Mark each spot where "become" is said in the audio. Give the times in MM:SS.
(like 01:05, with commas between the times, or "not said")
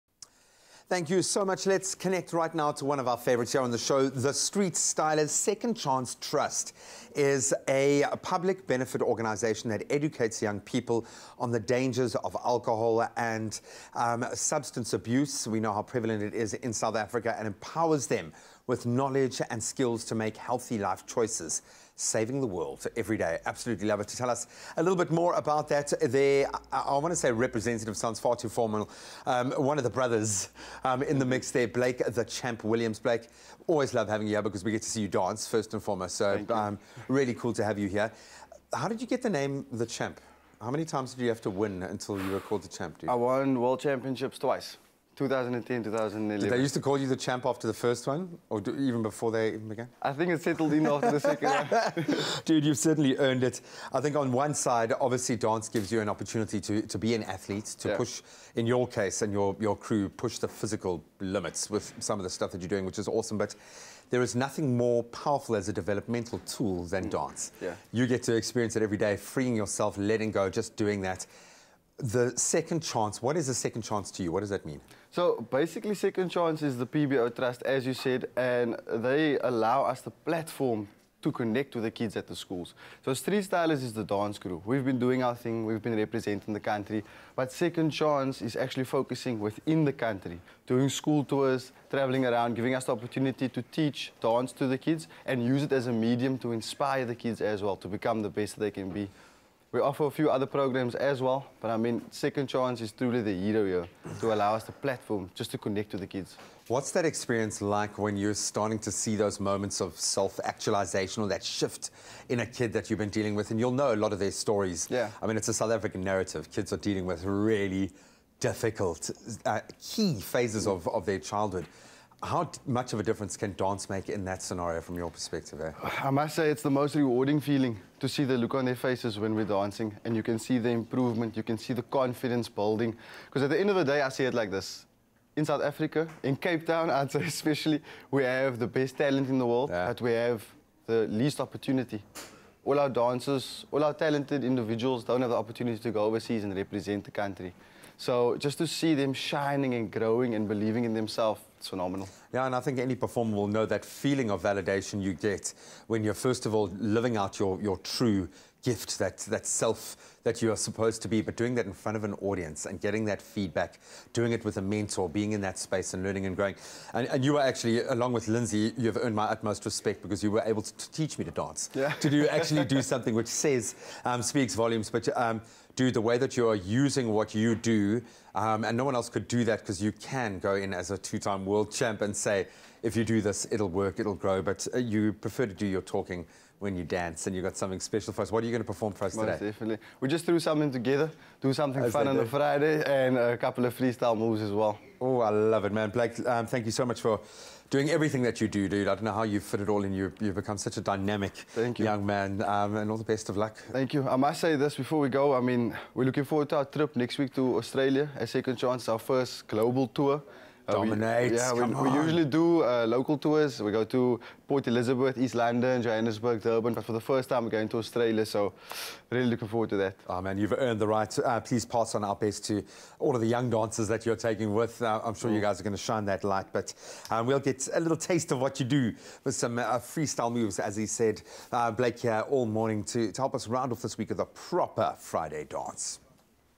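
01:37, 03:20.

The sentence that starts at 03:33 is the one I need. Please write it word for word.
We go to Port Elizabeth, East London, Johannesburg, Durban.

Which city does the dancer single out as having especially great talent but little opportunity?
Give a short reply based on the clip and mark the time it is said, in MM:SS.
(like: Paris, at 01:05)
Cape Town, at 02:16.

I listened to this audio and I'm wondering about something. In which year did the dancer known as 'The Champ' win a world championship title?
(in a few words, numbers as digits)
2010.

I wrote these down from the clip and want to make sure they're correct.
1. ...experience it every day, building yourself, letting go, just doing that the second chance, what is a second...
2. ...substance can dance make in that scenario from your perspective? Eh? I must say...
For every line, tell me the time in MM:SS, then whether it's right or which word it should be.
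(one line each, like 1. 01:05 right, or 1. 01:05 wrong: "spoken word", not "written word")
1. 01:08 wrong: "freeing", not "building"
2. 02:03 wrong: "difference", not "substance".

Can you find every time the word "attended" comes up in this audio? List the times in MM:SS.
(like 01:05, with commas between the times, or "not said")
not said.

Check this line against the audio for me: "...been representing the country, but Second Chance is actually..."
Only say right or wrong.
right.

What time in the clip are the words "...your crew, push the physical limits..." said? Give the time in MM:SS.
00:59.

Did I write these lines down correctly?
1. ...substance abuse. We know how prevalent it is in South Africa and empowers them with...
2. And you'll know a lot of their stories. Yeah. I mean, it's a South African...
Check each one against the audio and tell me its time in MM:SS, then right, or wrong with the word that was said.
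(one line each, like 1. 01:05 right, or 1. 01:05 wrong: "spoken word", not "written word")
1. 00:14 right
2. 01:53 right.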